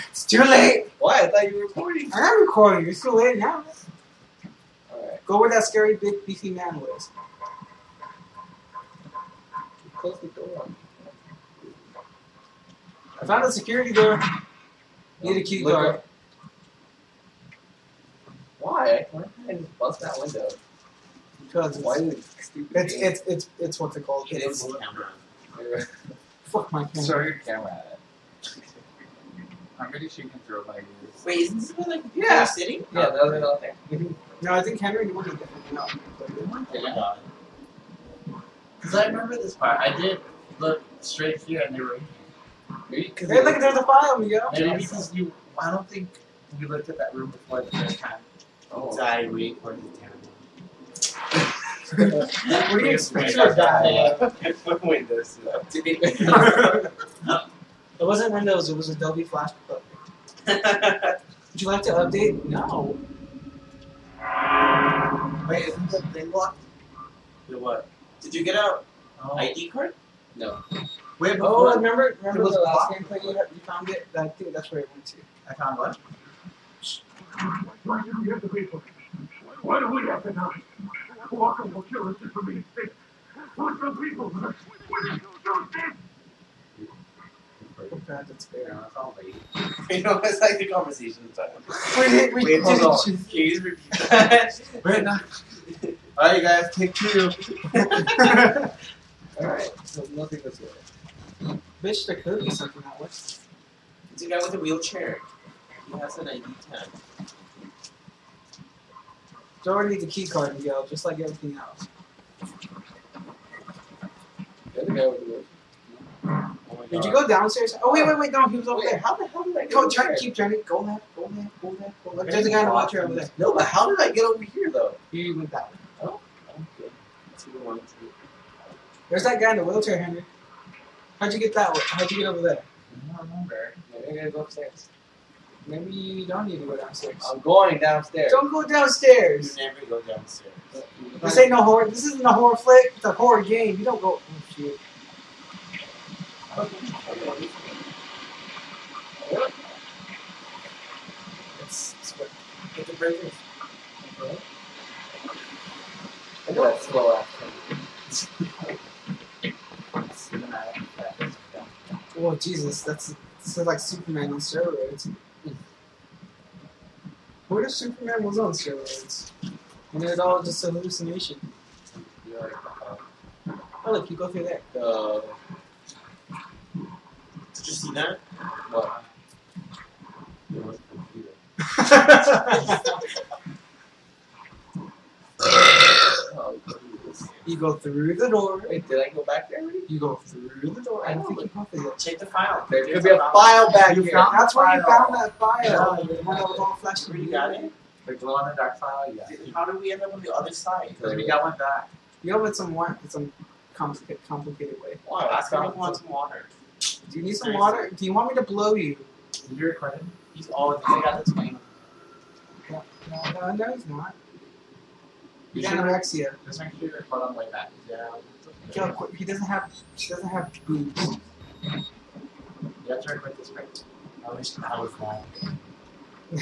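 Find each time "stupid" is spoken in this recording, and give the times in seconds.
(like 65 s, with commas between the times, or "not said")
22 s, 85 s.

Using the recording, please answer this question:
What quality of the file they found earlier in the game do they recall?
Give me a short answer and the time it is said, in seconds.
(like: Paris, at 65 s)
glow in the dark, at 198 s.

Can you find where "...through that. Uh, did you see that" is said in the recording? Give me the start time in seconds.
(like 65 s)
174 s.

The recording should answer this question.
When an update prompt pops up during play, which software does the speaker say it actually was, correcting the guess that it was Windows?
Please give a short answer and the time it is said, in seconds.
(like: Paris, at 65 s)
Adobe Flash, at 58 s.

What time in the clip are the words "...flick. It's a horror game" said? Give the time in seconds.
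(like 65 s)
142 s.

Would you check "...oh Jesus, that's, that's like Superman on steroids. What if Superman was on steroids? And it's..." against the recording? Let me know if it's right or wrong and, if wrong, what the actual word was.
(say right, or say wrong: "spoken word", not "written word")
right.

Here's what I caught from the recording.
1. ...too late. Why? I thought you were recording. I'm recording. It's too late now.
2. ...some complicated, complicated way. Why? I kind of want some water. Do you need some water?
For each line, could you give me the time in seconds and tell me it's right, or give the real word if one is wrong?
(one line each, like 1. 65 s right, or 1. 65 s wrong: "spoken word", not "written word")
1. 0 s right
2. 203 s right.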